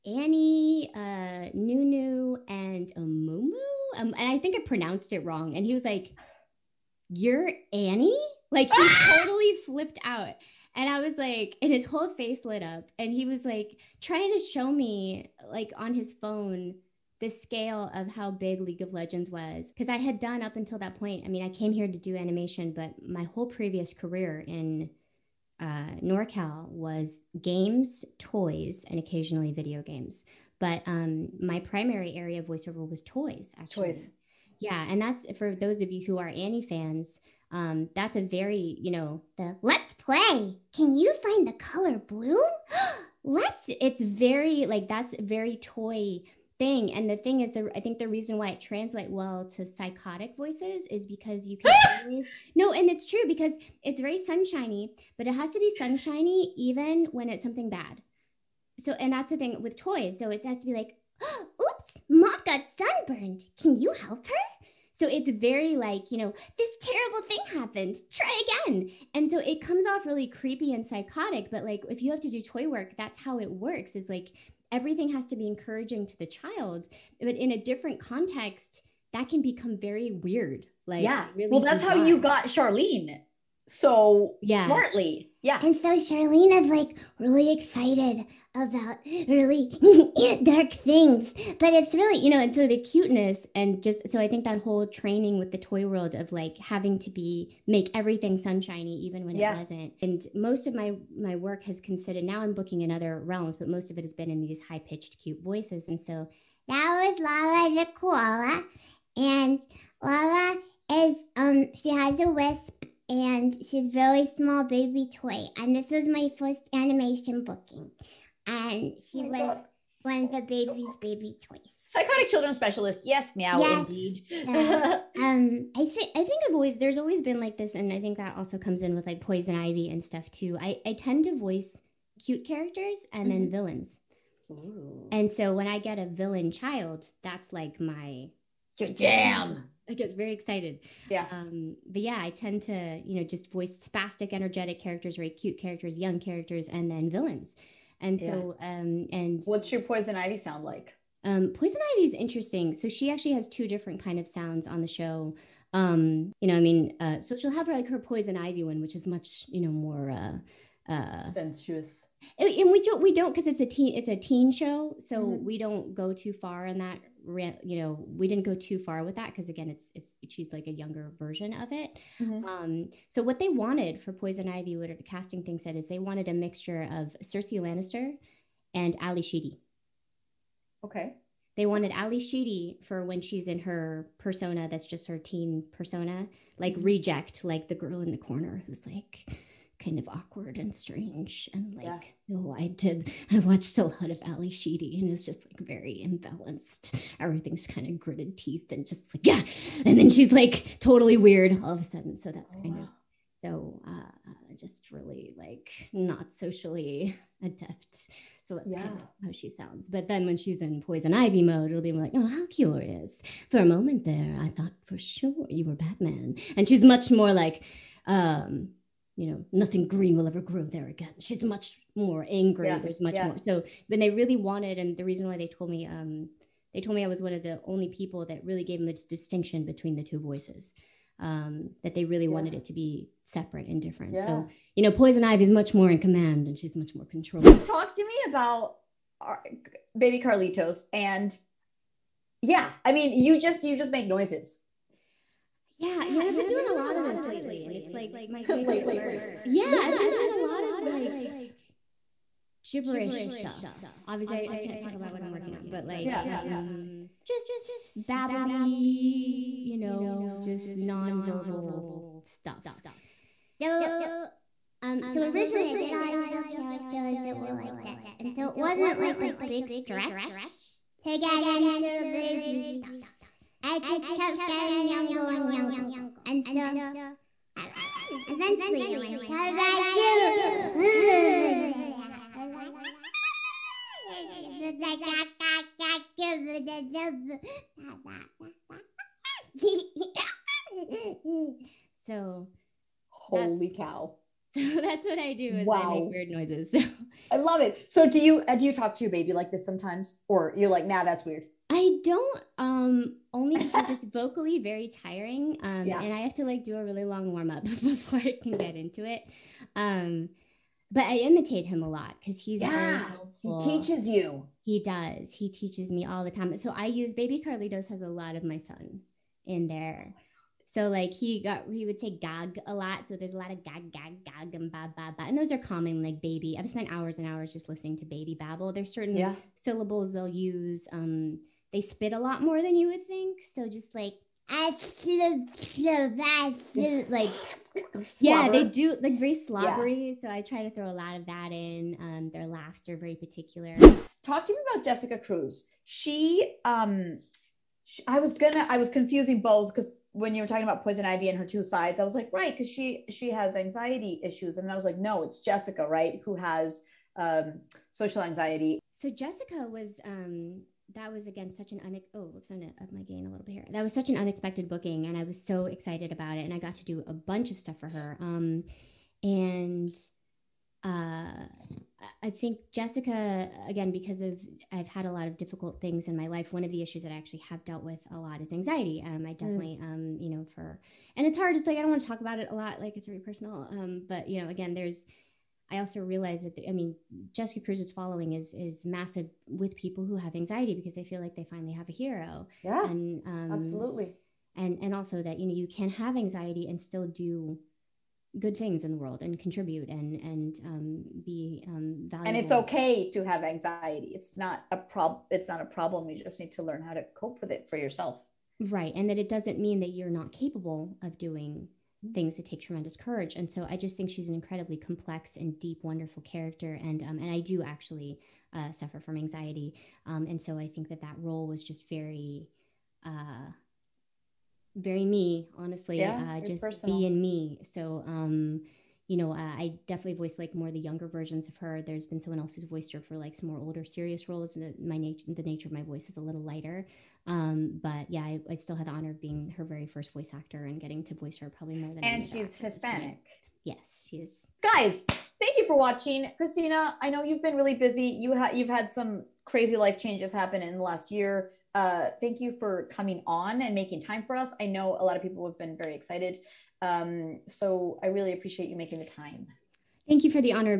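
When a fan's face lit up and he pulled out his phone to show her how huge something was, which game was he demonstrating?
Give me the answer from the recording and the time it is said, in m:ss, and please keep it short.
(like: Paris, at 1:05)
League of Legends, at 0:18.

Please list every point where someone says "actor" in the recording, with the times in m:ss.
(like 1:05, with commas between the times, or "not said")
7:20.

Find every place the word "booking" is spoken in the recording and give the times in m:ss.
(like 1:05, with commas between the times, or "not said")
1:42, 1:57, 6:04.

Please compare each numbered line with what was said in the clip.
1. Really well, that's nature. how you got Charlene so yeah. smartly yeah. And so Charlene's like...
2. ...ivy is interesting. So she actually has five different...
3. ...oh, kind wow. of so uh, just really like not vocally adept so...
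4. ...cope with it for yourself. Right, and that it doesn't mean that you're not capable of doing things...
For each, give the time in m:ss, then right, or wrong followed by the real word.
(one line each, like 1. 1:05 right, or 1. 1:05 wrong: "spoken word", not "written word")
1. 1:21 wrong: "bizarre", not "nature"
2. 2:31 wrong: "two", not "five"
3. 3:22 wrong: "socially", not "vocally"
4. 6:47 right.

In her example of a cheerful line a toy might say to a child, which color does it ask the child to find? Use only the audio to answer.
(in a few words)
Blue.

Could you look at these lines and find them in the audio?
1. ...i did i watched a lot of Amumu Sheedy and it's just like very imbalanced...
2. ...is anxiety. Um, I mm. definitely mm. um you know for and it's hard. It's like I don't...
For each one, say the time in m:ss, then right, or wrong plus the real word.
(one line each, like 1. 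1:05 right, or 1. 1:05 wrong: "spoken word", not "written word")
1. 3:12 wrong: "Ally", not "Amumu"
2. 6:18 right.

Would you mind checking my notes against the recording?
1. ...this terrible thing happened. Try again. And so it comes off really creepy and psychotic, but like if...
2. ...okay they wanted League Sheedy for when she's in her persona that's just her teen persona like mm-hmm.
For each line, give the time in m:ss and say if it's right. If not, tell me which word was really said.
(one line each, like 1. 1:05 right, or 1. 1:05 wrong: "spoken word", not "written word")
1. 1:06 right
2. 3:00 wrong: "Ally", not "League".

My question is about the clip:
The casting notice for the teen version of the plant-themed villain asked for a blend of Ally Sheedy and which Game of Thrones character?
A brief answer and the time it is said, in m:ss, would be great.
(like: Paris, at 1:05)
Cersei Lannister, at 2:57.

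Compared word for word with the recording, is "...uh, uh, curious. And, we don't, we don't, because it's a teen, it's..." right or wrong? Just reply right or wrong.
wrong.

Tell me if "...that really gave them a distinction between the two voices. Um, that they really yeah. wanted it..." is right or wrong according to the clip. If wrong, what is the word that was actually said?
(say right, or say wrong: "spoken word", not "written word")
right.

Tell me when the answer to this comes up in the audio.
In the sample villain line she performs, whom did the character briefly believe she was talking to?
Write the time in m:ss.
3:35.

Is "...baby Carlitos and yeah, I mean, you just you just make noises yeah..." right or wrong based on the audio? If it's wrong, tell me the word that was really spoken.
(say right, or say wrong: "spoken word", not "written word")
right.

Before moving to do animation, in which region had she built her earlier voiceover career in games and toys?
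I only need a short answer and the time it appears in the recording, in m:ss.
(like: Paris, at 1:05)
NorCal, at 0:26.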